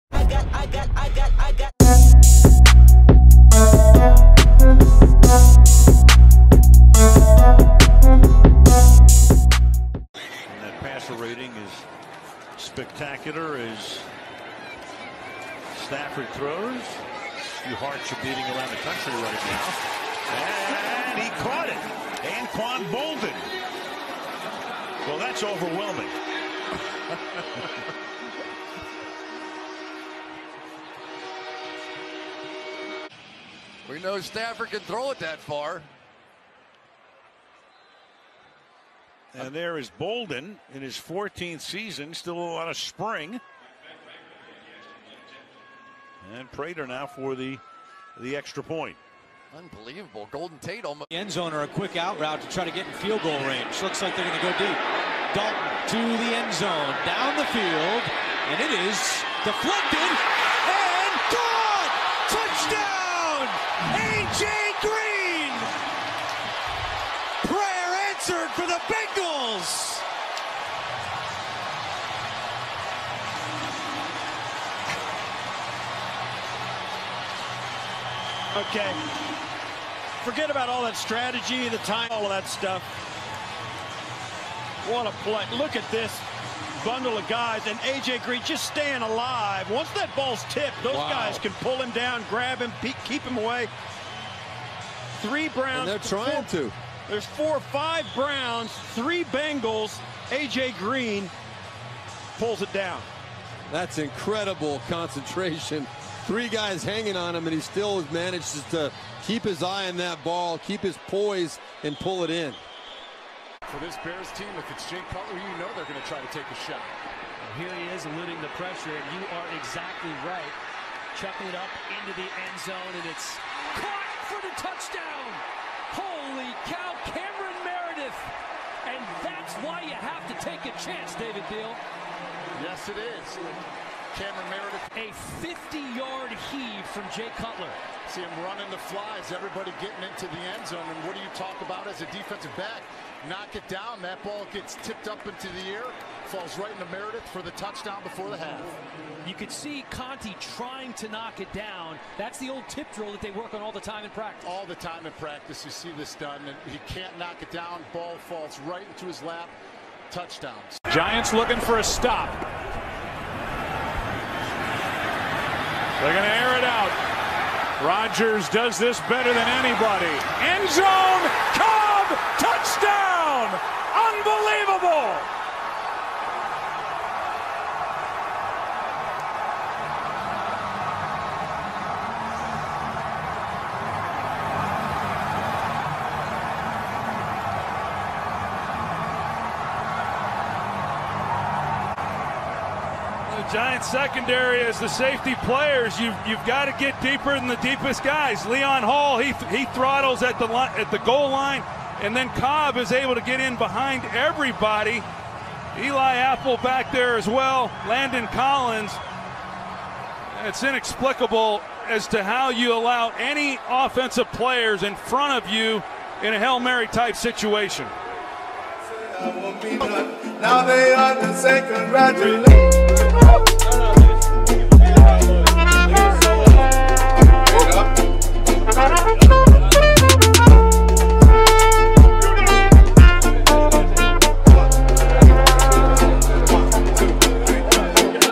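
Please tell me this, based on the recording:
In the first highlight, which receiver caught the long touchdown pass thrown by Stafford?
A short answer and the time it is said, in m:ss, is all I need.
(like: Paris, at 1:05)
Anquan Boldin, at 0:22.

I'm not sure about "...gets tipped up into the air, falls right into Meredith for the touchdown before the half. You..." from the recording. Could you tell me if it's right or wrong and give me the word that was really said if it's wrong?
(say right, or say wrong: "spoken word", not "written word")
right.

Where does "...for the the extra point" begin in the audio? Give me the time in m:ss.
0:47.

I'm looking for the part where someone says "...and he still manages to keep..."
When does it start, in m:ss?
1:47.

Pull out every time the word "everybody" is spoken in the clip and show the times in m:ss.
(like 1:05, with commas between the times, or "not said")
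2:19, 3:24.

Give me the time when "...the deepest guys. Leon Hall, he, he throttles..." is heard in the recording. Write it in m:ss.
3:17.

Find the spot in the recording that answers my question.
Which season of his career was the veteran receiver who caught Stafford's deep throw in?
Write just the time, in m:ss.
0:40.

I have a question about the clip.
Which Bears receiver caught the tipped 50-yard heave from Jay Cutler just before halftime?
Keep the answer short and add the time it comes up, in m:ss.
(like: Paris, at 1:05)
Cameron Meredith, at 2:14.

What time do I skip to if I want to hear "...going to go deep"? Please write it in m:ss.
0:54.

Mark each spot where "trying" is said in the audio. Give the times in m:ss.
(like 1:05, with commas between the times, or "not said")
1:35, 2:30.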